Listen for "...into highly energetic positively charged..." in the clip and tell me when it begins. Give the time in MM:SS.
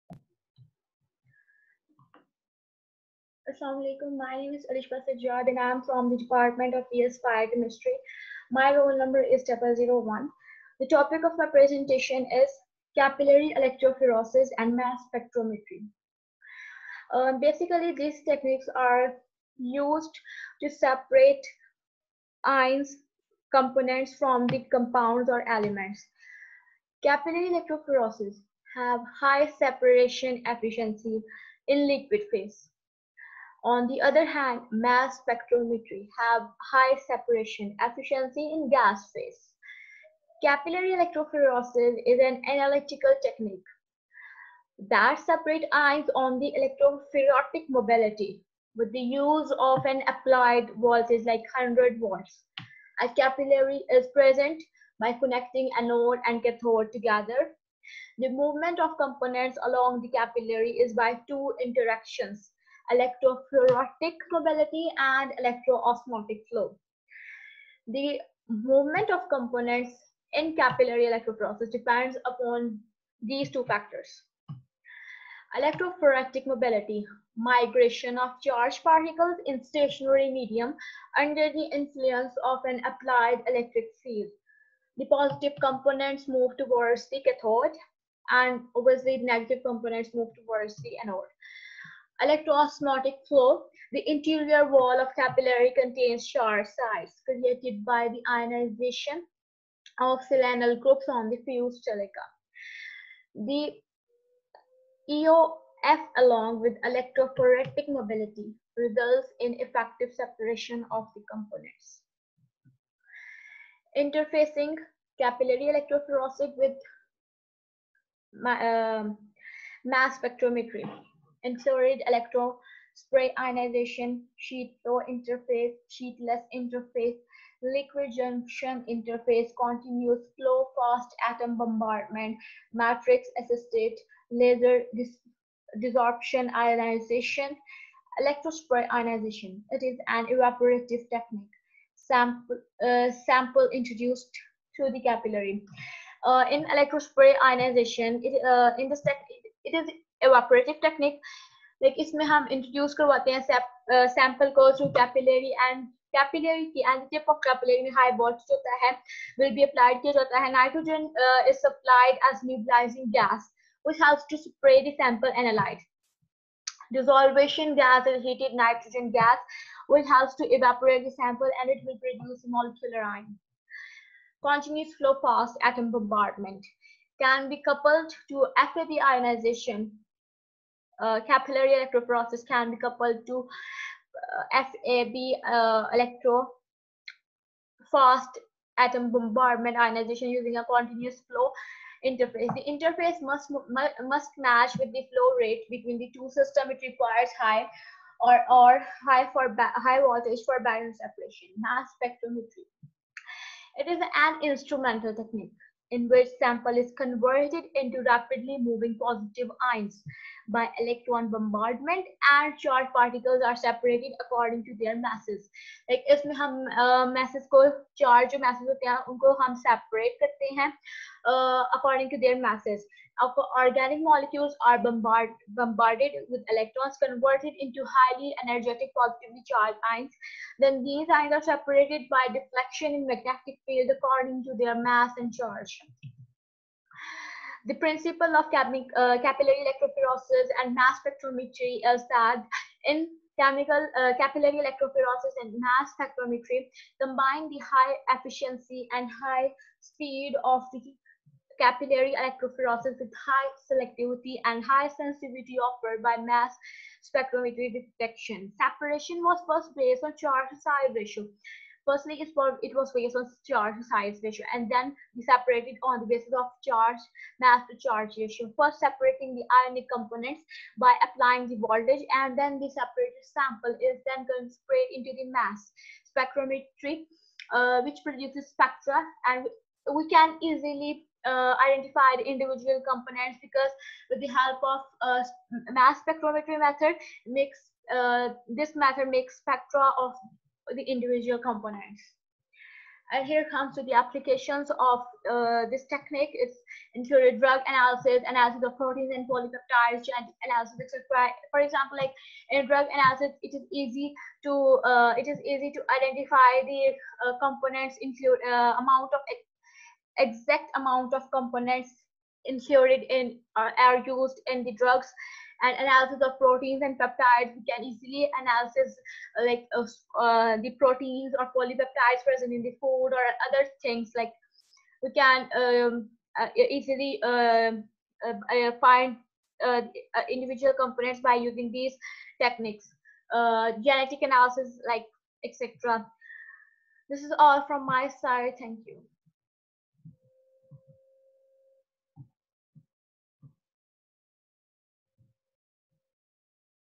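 03:47.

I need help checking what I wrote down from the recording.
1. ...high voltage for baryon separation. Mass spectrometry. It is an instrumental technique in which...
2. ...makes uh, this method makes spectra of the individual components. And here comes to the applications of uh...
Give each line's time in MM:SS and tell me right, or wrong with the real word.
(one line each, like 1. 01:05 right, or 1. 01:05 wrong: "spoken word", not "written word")
1. 03:19 right
2. 04:47 right.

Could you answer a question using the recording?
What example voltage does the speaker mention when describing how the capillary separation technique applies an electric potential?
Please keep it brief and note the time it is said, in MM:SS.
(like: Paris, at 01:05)
100 volts, at 00:51.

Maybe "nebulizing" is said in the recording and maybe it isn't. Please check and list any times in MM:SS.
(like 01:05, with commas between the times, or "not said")
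02:42.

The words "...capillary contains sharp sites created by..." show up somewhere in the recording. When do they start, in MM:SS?
01:35.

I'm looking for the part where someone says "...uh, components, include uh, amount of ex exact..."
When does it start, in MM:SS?
05:07.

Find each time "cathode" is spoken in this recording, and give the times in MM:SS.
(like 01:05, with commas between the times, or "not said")
00:56, 01:27.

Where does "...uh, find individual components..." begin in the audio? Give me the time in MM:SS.
05:28.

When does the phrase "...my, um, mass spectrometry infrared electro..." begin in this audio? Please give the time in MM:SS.
01:58.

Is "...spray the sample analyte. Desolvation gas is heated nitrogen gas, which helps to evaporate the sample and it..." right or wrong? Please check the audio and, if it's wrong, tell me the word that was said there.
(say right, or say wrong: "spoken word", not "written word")
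right.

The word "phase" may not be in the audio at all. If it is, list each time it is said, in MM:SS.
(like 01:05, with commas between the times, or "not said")
00:32, 00:39.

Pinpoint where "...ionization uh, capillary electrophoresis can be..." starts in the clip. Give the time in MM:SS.
02:59.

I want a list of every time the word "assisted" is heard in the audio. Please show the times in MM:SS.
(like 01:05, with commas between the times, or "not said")
02:13.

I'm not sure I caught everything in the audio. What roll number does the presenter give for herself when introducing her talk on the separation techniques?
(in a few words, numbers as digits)
001.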